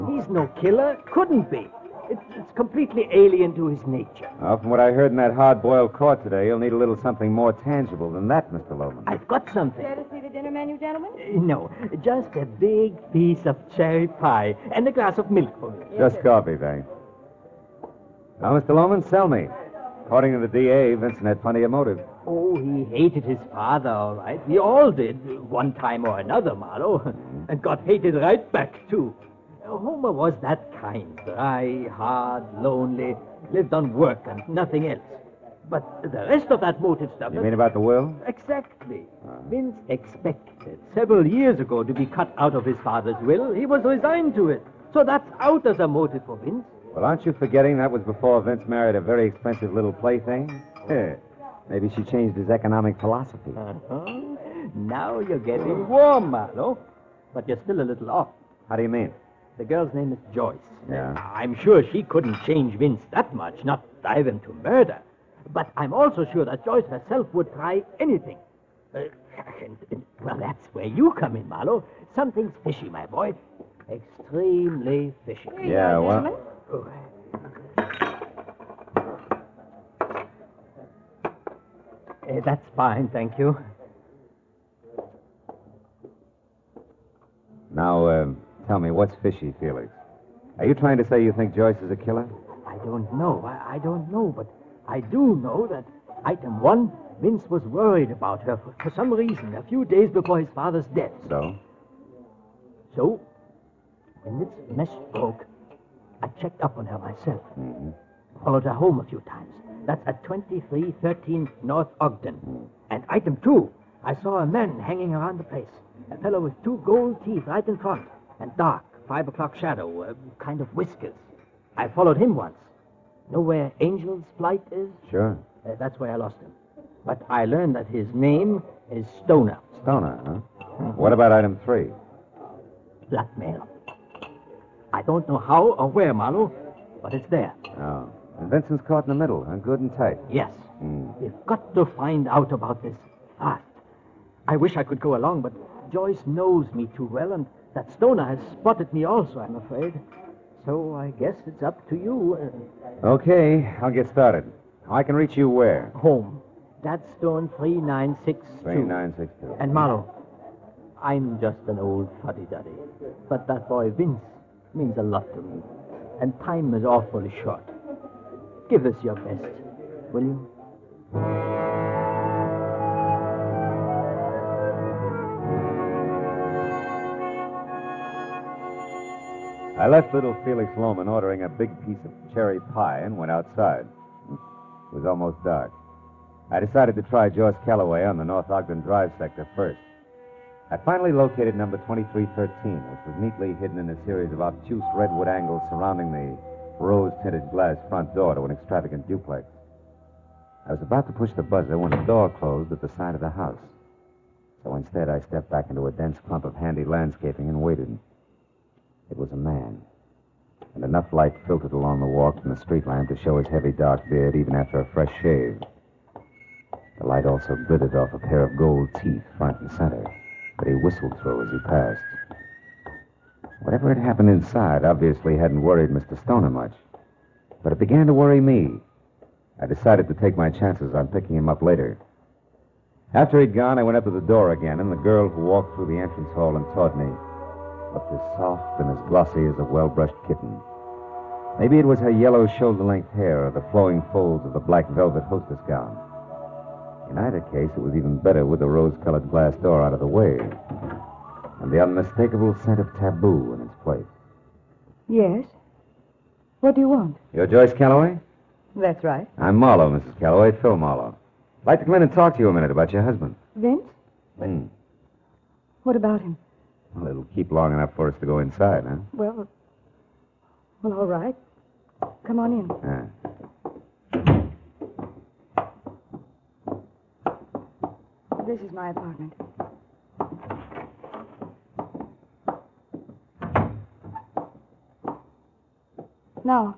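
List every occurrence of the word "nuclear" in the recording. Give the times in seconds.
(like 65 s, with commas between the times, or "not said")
not said.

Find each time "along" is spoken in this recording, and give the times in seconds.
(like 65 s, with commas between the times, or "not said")
145 s, 211 s.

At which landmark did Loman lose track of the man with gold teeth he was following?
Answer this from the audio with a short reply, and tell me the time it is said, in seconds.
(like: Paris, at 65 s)
Angel's Flight, at 123 s.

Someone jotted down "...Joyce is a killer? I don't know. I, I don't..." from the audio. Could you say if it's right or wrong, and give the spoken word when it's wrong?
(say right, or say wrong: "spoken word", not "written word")
right.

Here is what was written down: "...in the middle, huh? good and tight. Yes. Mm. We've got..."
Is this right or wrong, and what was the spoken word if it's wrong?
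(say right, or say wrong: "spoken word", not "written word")
right.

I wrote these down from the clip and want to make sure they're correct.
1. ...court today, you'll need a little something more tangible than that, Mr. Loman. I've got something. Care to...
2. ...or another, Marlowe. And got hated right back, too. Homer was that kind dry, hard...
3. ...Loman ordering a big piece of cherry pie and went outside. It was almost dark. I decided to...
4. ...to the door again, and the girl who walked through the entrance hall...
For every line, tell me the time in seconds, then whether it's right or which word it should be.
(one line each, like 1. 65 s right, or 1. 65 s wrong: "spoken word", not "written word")
1. 5 s right
2. 26 s right
3. 180 s right
4. 234 s right.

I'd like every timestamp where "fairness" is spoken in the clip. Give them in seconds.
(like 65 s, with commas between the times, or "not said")
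not said.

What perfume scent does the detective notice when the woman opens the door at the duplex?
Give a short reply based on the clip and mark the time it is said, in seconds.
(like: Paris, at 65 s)
Tabu, at 252 s.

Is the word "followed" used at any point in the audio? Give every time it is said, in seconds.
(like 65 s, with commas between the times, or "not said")
108 s, 121 s.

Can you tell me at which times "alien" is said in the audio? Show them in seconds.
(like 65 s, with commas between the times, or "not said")
3 s.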